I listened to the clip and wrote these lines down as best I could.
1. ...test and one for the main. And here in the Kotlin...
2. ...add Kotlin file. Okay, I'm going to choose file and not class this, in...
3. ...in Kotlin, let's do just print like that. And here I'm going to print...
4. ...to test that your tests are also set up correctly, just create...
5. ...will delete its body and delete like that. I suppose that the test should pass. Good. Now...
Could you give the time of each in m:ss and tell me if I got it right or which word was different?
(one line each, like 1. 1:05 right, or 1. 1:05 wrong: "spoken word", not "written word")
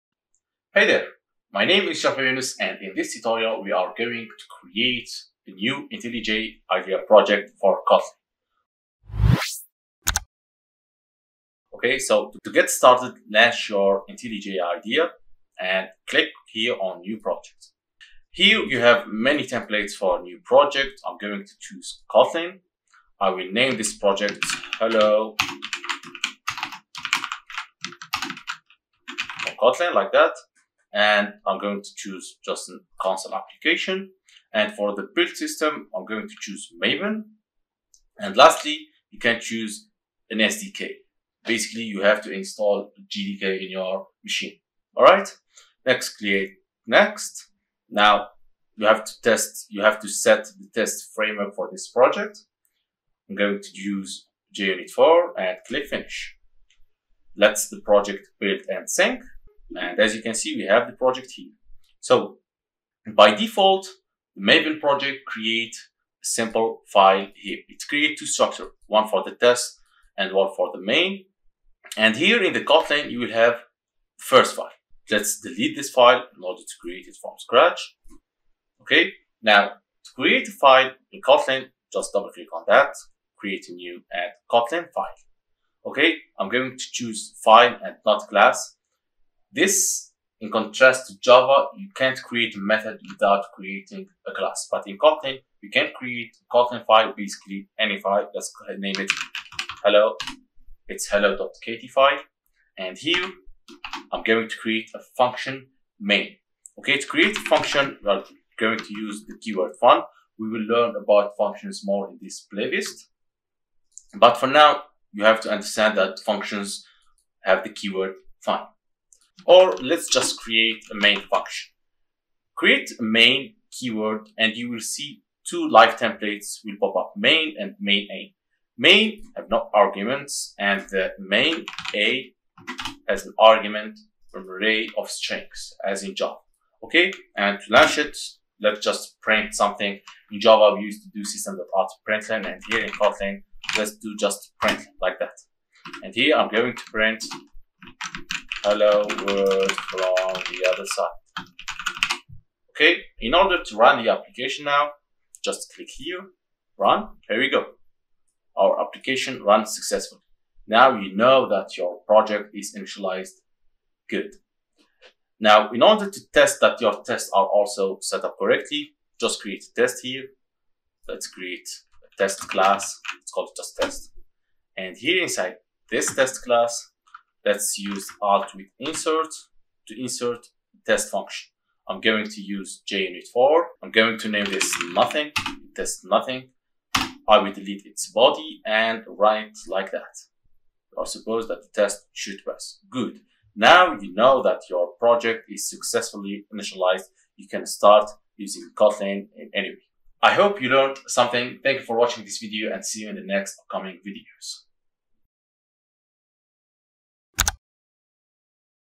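1. 1:09 right
2. 1:24 right
3. 2:22 right
4. 2:46 right
5. 3:07 wrong: "write", not "delete".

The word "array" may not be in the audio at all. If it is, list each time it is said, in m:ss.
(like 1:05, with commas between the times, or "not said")
2:14.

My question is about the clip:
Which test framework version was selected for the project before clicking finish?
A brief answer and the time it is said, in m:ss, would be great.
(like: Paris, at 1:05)
JUnit 4, at 0:54.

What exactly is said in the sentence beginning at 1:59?
Or let's just create a main function.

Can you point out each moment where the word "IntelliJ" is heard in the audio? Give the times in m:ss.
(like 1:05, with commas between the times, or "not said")
0:05, 0:14.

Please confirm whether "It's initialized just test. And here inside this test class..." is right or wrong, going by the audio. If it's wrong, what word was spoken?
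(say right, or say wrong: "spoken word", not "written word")
wrong: "called", not "initialized".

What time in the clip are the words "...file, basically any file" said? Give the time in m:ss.
1:36.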